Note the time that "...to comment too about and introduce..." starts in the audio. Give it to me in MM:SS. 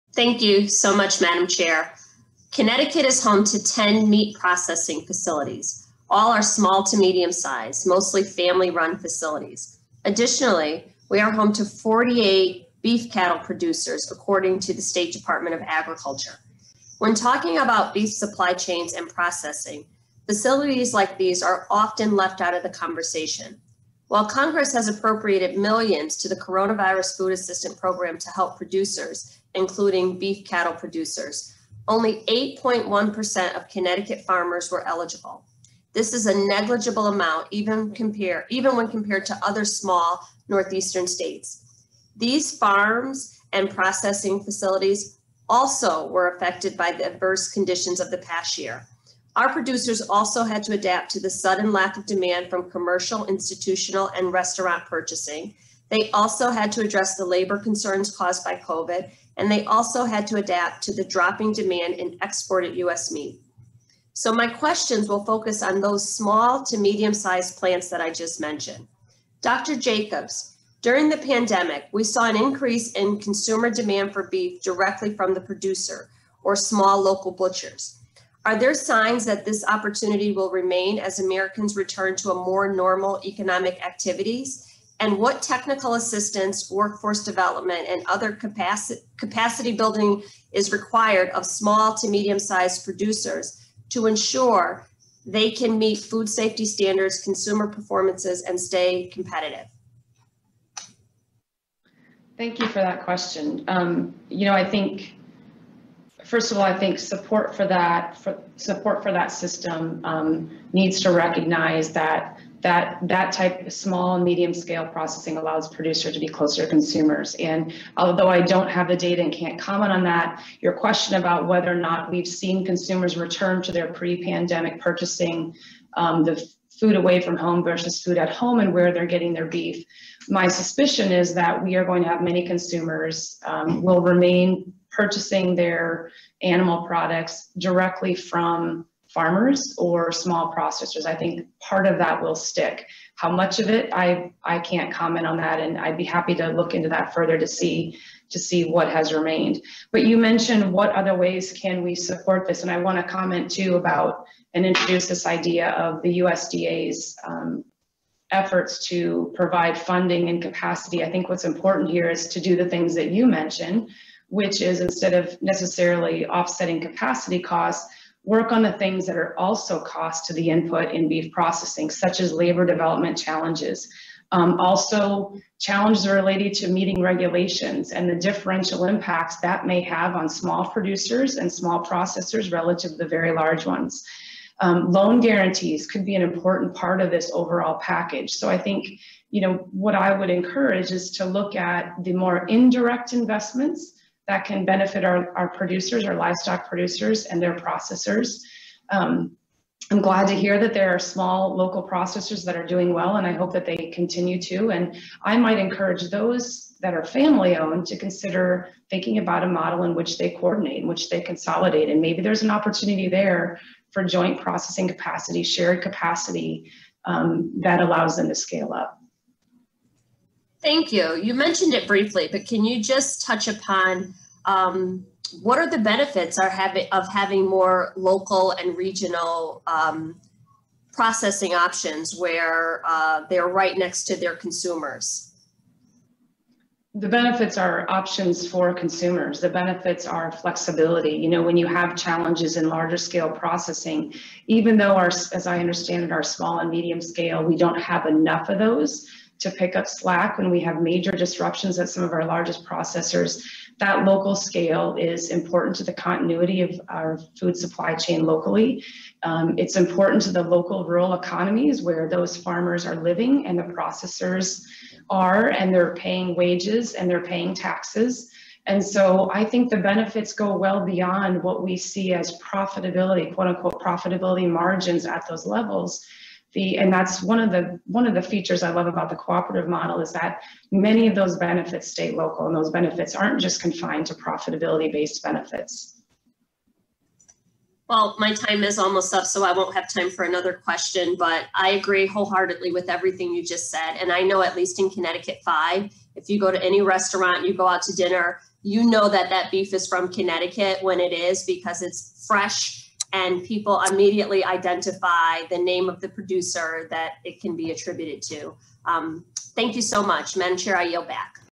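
02:32.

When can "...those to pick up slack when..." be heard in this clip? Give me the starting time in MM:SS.
04:08.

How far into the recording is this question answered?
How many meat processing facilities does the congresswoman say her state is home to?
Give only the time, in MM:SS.
00:03.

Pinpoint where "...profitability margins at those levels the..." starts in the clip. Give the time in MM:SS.
04:33.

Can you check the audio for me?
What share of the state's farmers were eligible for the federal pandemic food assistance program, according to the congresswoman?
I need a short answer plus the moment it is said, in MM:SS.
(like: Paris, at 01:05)
8.1%, at 00:32.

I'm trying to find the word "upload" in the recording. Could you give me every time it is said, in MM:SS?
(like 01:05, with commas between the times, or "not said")
not said.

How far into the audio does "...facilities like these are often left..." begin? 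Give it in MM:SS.
00:20.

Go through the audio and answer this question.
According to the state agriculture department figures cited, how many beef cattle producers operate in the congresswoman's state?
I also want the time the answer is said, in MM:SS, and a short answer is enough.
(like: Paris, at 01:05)
48, at 00:11.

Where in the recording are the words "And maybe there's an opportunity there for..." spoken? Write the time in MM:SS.
03:31.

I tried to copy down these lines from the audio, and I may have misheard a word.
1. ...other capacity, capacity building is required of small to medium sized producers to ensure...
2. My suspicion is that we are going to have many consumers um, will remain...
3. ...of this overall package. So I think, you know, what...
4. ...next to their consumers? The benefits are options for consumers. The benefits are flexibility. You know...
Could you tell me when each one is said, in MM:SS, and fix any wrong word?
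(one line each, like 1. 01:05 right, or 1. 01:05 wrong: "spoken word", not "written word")
1. 01:28 right
2. 02:10 right
3. 03:07 right
4. 03:53 right.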